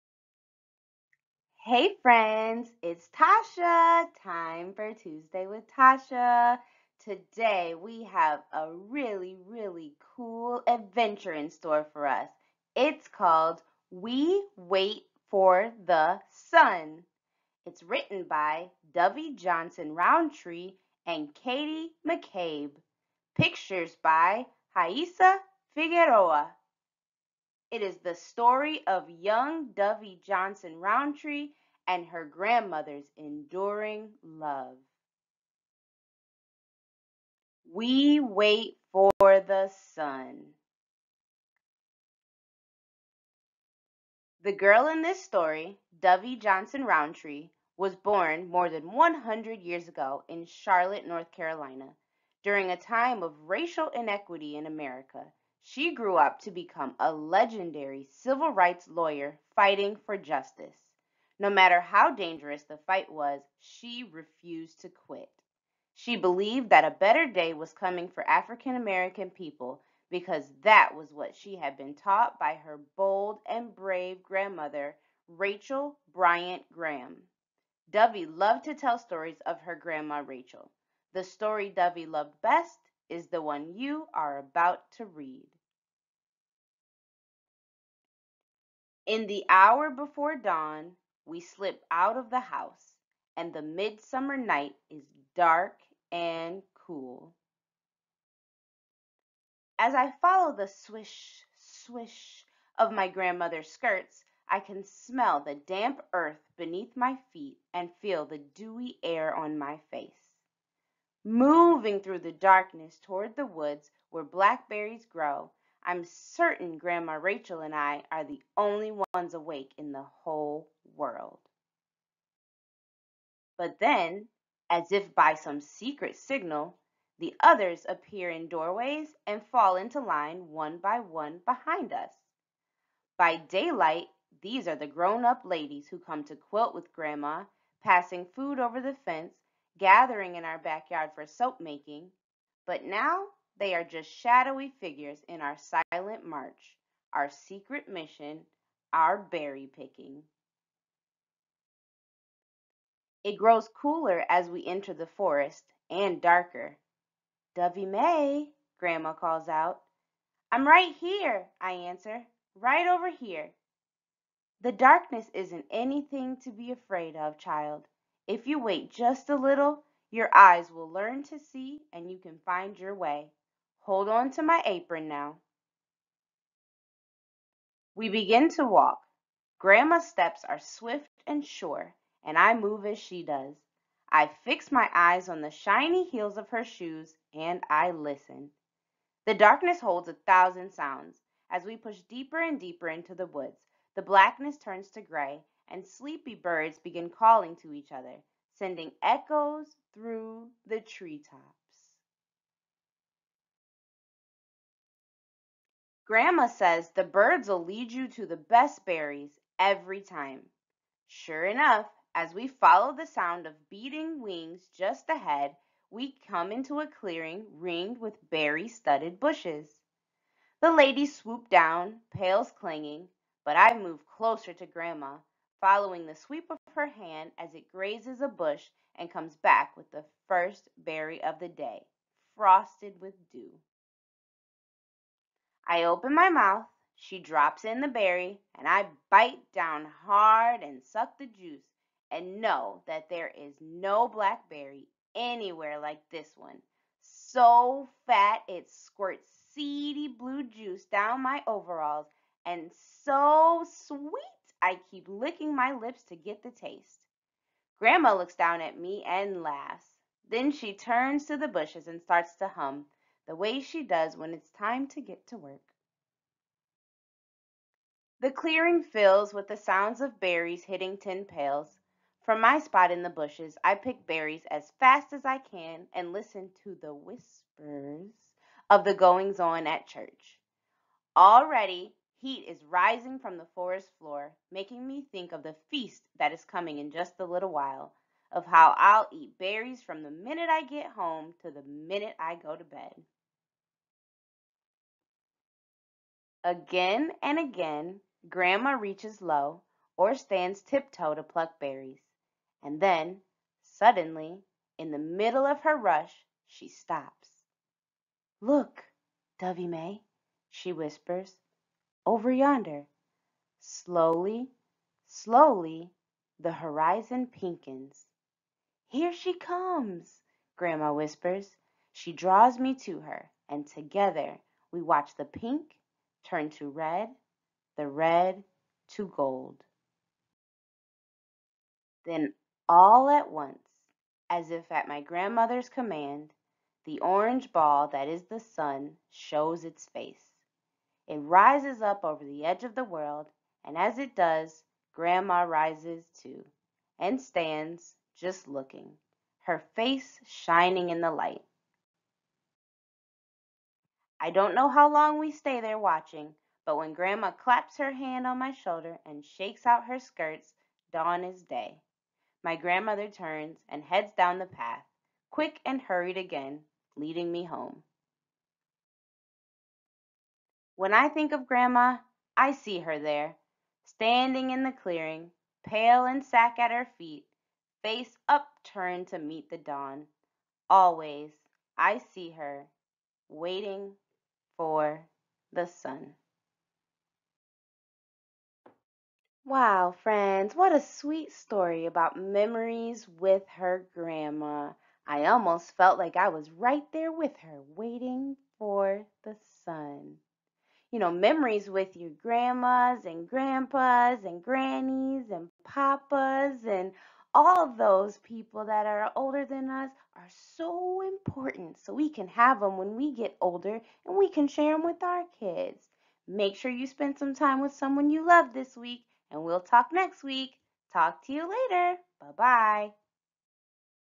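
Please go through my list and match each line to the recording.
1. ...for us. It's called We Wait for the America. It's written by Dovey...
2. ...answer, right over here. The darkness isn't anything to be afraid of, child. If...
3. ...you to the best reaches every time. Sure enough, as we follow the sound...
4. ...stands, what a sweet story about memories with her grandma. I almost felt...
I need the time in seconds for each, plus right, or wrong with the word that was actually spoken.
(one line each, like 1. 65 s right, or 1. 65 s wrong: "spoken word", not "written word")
1. 11 s wrong: "Sun", not "America"
2. 161 s right
3. 207 s wrong: "berries", not "reaches"
4. 390 s wrong: "friends", not "stands".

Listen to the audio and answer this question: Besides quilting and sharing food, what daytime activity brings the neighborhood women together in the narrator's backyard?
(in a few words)
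soap making.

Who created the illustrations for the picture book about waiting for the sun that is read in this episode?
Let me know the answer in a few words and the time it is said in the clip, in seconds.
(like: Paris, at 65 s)
Raissa Figueroa, at 24 s.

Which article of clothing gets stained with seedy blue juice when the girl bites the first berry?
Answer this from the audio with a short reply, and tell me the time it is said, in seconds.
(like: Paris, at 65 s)
overalls, at 251 s.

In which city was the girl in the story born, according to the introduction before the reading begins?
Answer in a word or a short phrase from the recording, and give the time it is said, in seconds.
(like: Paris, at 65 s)
Charlotte, North Carolina, at 50 s.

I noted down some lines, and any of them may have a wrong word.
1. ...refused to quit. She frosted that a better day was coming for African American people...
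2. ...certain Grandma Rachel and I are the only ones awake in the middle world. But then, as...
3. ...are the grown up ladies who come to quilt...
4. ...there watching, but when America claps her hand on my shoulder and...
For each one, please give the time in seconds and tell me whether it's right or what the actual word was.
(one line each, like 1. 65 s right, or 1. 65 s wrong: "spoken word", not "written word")
1. 64 s wrong: "believed", not "frosted"
2. 116 s wrong: "whole", not "middle"
3. 134 s right
4. 355 s wrong: "Grandma", not "America".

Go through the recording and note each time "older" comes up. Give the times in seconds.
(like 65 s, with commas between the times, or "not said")
409 s, 413 s.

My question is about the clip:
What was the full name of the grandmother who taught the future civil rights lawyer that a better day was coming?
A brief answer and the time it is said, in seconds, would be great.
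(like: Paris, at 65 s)
Rachel Bryant Graham, at 75 s.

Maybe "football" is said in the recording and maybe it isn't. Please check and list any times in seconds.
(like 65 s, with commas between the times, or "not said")
not said.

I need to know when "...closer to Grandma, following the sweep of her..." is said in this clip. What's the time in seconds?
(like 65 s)
224 s.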